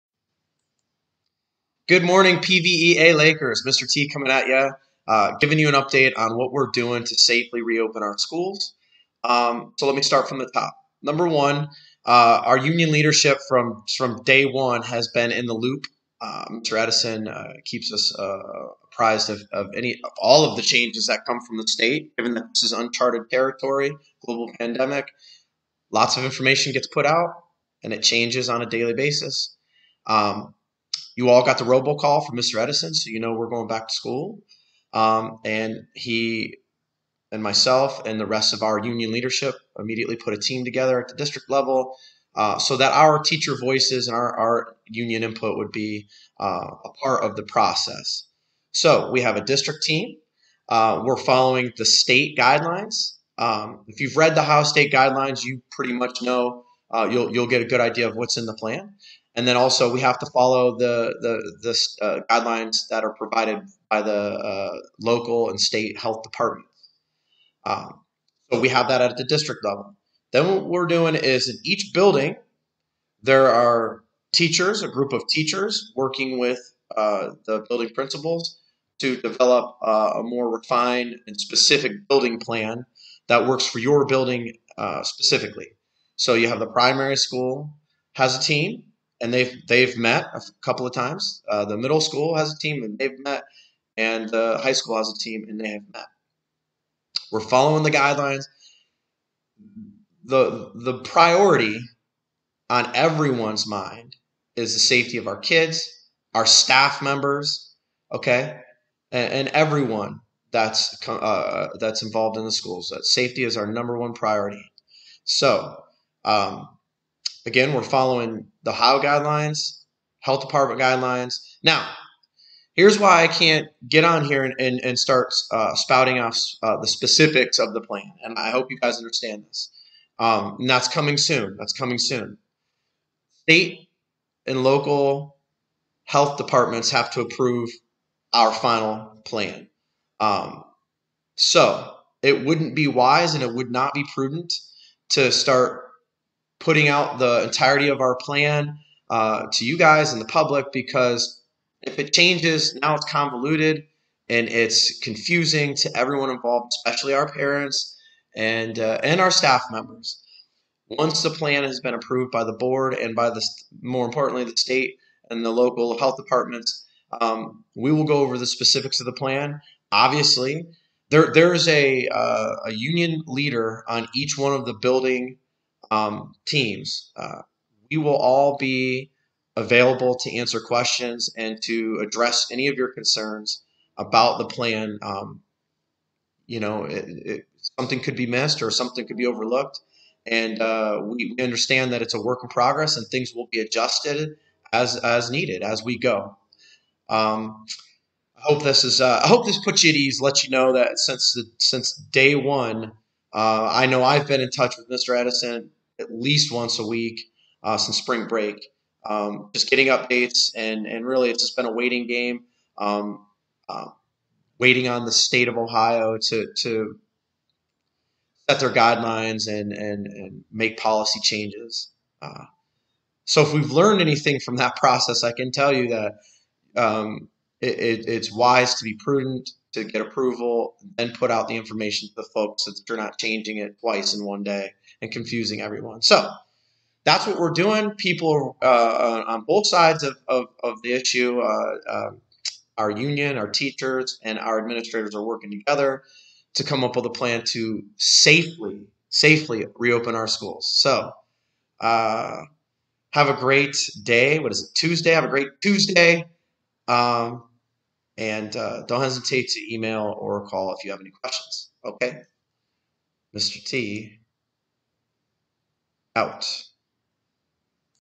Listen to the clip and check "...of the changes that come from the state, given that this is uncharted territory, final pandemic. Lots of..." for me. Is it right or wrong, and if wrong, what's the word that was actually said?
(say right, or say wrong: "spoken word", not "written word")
wrong: "global", not "final".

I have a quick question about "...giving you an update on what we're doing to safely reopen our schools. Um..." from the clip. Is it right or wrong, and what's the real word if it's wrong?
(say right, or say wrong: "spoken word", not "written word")
right.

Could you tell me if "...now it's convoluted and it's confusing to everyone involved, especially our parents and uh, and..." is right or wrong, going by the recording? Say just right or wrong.
right.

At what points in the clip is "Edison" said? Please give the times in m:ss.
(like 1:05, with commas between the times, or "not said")
0:16, 0:32, 3:25.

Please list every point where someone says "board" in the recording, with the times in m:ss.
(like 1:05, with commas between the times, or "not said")
2:42.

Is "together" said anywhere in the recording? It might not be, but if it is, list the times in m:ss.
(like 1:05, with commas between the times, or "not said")
0:40, 4:05.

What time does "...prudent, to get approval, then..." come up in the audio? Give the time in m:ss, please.
3:48.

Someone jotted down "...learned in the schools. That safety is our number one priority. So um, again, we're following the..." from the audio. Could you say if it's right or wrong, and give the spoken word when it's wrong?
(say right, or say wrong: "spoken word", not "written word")
wrong: "involved", not "learned".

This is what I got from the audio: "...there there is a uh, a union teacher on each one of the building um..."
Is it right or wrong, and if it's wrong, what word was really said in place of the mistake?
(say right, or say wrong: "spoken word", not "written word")
wrong: "leader", not "teacher".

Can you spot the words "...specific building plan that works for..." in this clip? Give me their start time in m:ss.
1:21.